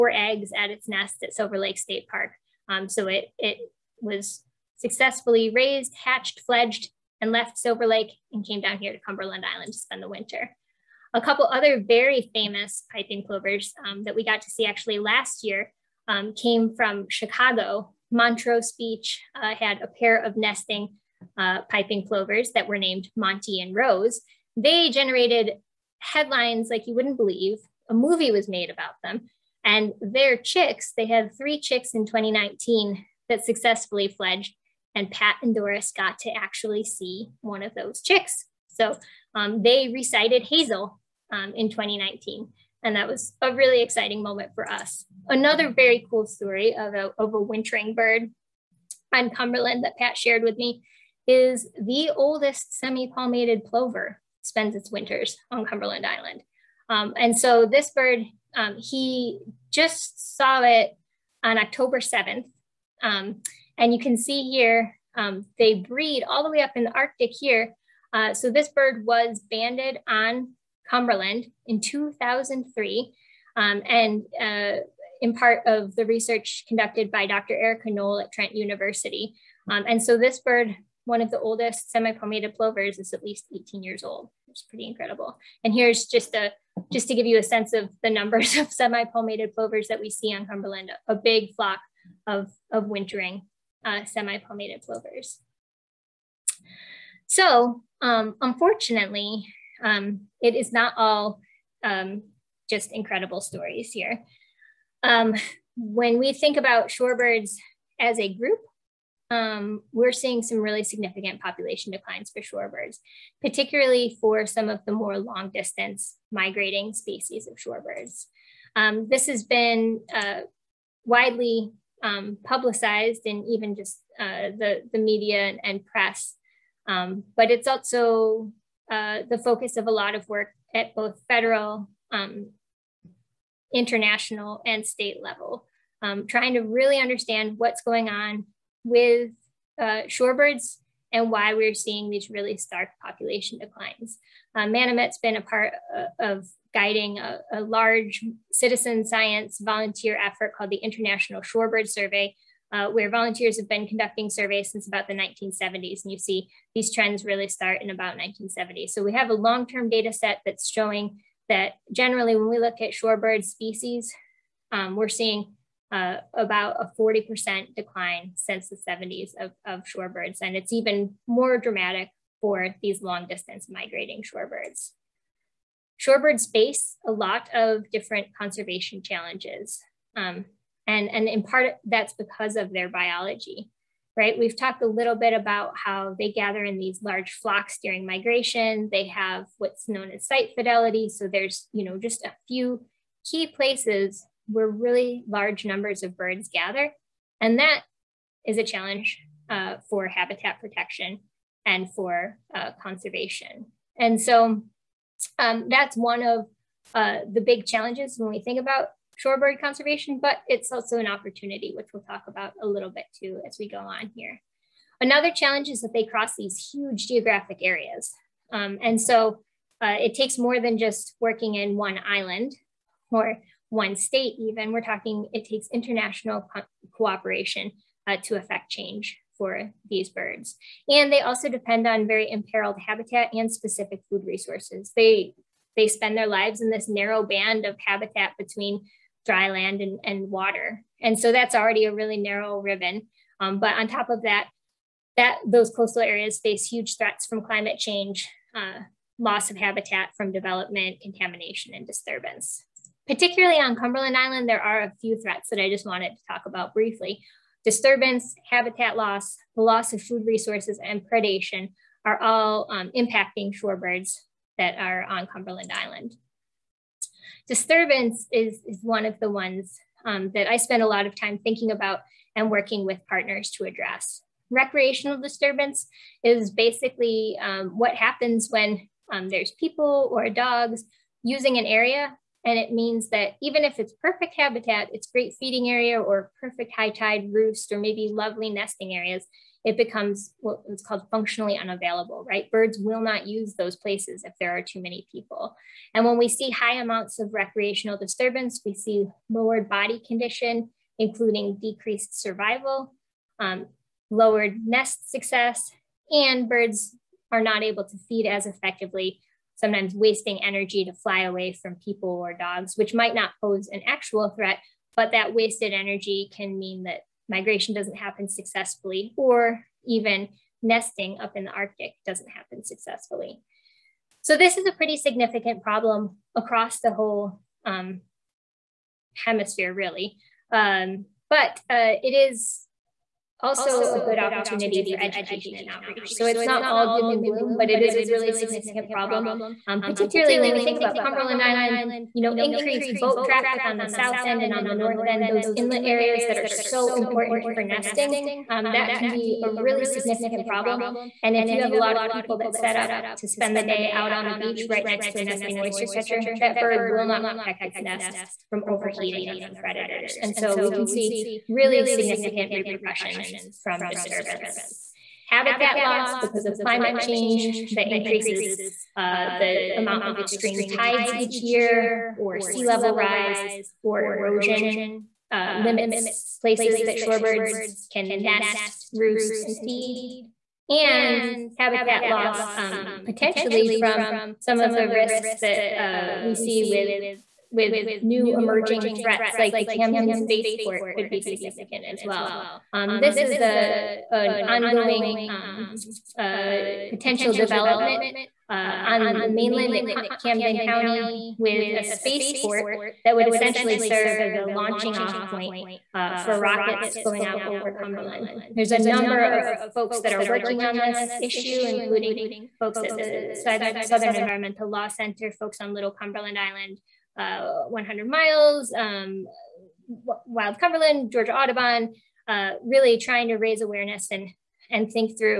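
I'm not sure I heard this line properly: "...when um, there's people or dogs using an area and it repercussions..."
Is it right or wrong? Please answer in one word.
wrong.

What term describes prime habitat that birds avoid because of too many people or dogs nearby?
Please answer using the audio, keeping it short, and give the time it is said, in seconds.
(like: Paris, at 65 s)
functionally unavailable, at 291 s.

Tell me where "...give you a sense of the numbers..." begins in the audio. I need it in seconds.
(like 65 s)
87 s.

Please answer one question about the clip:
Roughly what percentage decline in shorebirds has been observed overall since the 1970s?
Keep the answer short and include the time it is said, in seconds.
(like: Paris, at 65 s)
40%, at 166 s.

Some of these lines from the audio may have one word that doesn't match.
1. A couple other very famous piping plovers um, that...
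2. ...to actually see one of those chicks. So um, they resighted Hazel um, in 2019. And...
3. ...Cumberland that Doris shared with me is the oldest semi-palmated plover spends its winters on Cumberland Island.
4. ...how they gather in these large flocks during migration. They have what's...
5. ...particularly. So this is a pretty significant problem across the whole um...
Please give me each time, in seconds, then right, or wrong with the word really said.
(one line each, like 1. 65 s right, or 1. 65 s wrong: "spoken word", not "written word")
1. 11 s right
2. 36 s right
3. 49 s wrong: "Pat", not "Doris"
4. 185 s right
5. 322 s wrong: "successfully", not "particularly".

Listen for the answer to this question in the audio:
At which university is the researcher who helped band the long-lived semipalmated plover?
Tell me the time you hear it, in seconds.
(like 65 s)
78 s.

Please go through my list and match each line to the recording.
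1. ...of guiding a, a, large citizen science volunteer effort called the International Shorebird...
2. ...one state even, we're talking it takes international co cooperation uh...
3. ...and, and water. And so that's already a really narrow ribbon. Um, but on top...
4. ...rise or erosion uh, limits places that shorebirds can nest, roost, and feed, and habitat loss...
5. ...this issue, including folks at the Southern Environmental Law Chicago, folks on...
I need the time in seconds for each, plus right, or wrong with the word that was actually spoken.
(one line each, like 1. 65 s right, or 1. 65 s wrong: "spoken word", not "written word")
1. 146 s right
2. 223 s right
3. 239 s right
4. 372 s right
5. 410 s wrong: "Center", not "Chicago".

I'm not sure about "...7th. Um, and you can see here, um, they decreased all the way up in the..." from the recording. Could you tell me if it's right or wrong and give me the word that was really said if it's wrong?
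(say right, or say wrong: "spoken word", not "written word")
wrong: "breed", not "decreased".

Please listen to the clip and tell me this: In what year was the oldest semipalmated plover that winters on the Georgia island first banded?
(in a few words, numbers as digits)
2003.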